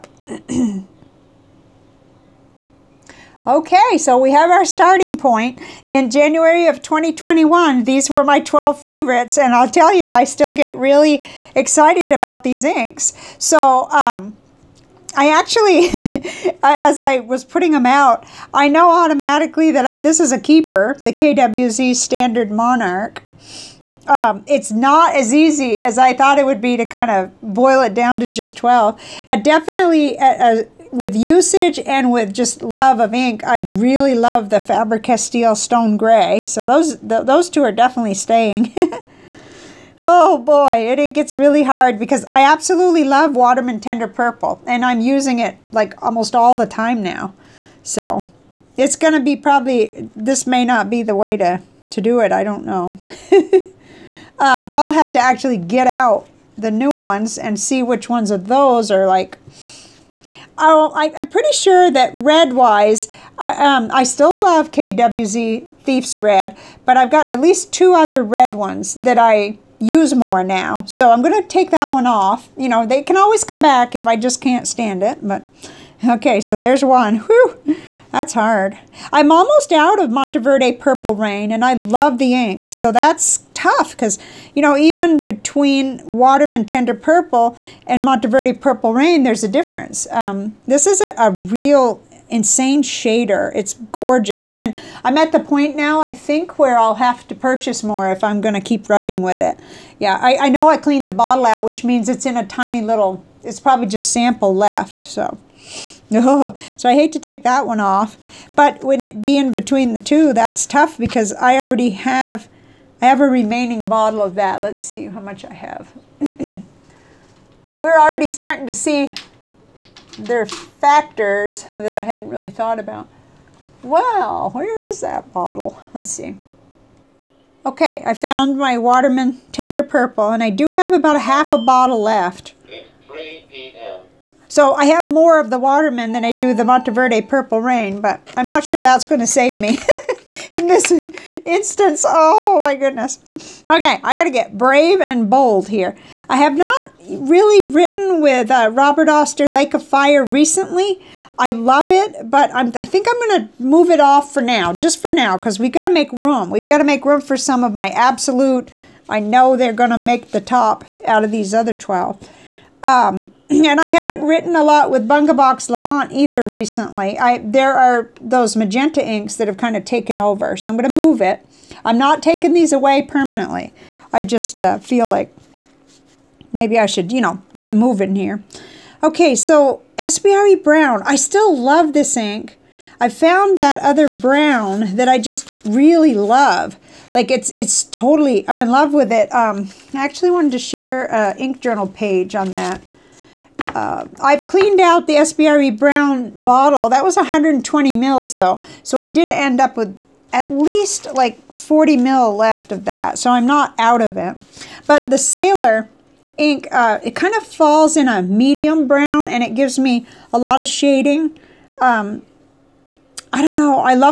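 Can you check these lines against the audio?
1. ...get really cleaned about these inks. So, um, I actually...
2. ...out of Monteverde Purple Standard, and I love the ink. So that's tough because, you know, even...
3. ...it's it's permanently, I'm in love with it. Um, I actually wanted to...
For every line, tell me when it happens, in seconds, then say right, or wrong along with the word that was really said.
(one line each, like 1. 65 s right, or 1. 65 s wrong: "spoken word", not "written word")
1. 10 s wrong: "excited", not "cleaned"
2. 79 s wrong: "Rain", not "Standard"
3. 187 s wrong: "totally", not "permanently".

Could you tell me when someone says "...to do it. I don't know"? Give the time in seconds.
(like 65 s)
51 s.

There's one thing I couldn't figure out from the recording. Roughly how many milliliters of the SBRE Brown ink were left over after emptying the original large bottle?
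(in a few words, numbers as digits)
40.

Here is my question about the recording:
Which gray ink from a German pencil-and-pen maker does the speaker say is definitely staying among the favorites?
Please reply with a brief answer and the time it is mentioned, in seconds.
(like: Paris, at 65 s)
Faber-Castell Stone Gray, at 34 s.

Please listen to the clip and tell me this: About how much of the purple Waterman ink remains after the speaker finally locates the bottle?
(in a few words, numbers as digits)
half a bottle.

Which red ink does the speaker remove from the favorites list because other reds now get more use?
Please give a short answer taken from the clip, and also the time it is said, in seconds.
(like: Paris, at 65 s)
KWZ Thief's Red, at 64 s.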